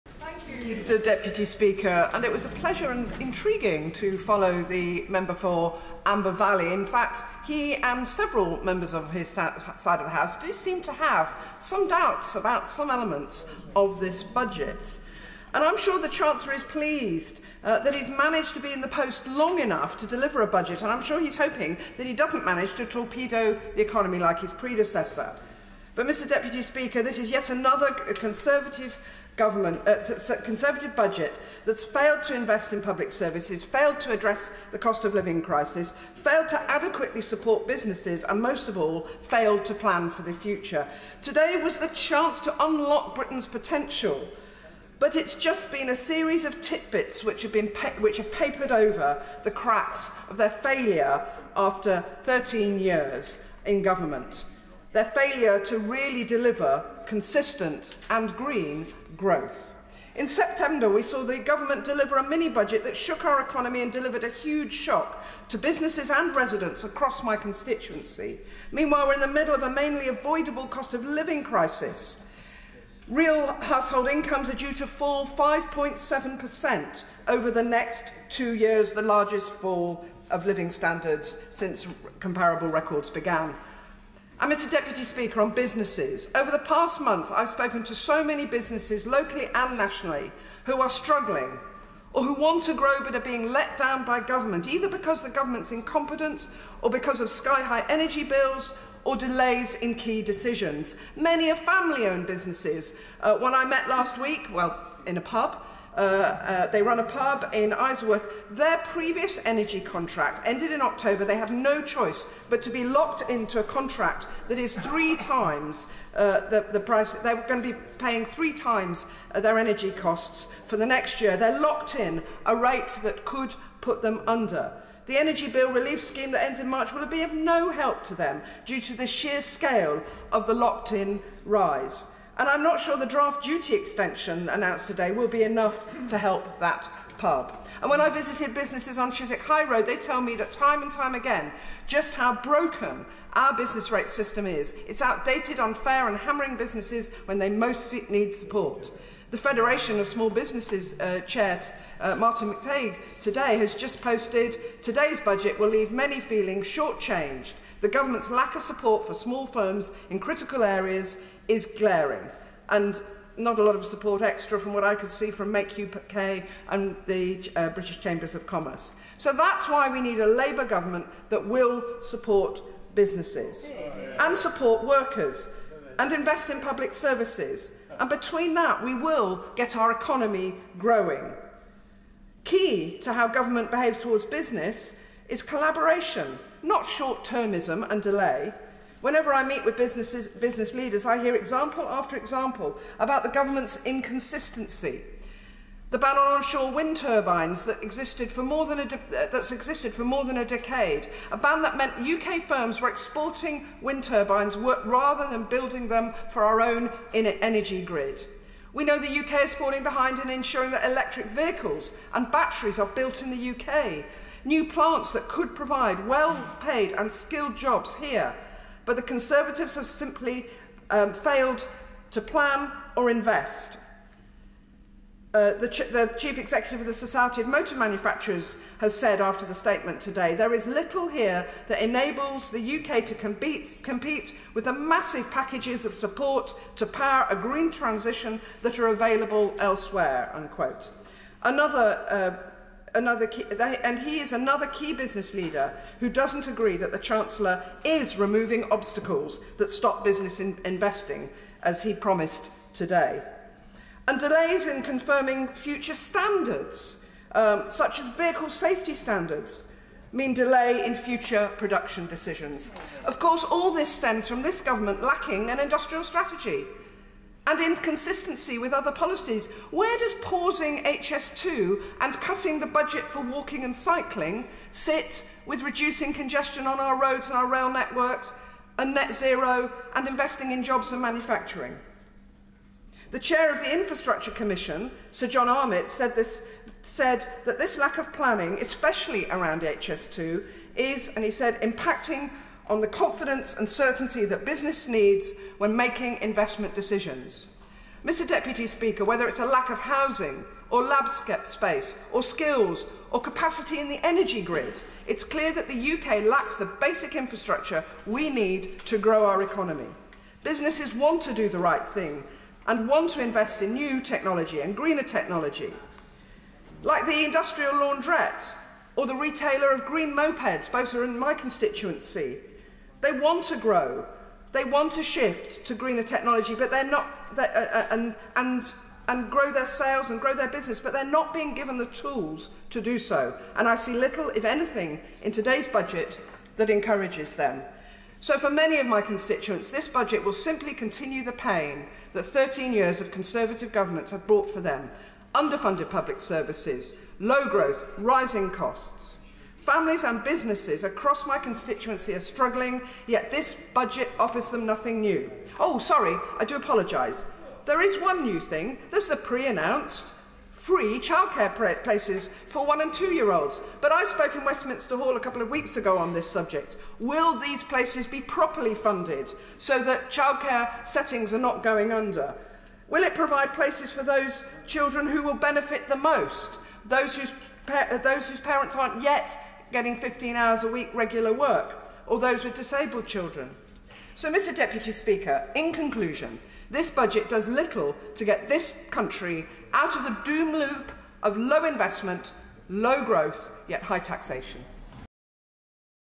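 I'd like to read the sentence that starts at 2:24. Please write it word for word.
It's outdated, unfair, and hammering businesses when they most need support.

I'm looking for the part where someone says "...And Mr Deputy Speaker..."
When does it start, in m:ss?
1:24.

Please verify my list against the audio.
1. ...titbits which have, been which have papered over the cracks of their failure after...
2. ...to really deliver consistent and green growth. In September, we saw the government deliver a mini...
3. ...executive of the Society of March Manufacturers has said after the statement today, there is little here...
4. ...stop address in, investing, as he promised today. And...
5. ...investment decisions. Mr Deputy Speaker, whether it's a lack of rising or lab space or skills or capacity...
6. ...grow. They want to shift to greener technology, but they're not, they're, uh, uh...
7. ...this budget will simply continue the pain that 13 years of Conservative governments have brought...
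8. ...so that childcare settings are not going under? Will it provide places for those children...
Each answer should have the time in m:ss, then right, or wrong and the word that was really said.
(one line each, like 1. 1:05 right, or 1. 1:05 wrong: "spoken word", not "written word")
1. 0:46 right
2. 0:55 right
3. 3:46 wrong: "Motor", not "March"
4. 4:09 wrong: "business", not "address"
5. 4:56 wrong: "housing", not "rising"
6. 5:23 right
7. 5:39 right
8. 6:09 right.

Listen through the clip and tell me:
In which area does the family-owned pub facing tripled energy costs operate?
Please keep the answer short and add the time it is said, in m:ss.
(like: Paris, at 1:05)
Isleworth, at 1:47.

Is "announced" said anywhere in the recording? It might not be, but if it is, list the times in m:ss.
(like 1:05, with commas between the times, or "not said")
2:14, 5:59.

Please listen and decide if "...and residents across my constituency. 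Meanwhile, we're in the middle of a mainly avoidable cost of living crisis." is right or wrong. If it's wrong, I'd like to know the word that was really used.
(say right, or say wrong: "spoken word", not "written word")
right.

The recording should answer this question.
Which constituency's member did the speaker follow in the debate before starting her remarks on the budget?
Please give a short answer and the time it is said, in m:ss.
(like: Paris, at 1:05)
Amber Valley, at 0:06.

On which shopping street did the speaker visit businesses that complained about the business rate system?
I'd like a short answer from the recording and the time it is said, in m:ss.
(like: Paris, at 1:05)
Chiswick High Road, at 2:19.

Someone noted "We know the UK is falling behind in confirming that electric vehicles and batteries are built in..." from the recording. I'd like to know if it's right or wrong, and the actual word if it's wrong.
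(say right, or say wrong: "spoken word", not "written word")
wrong: "ensuring", not "confirming".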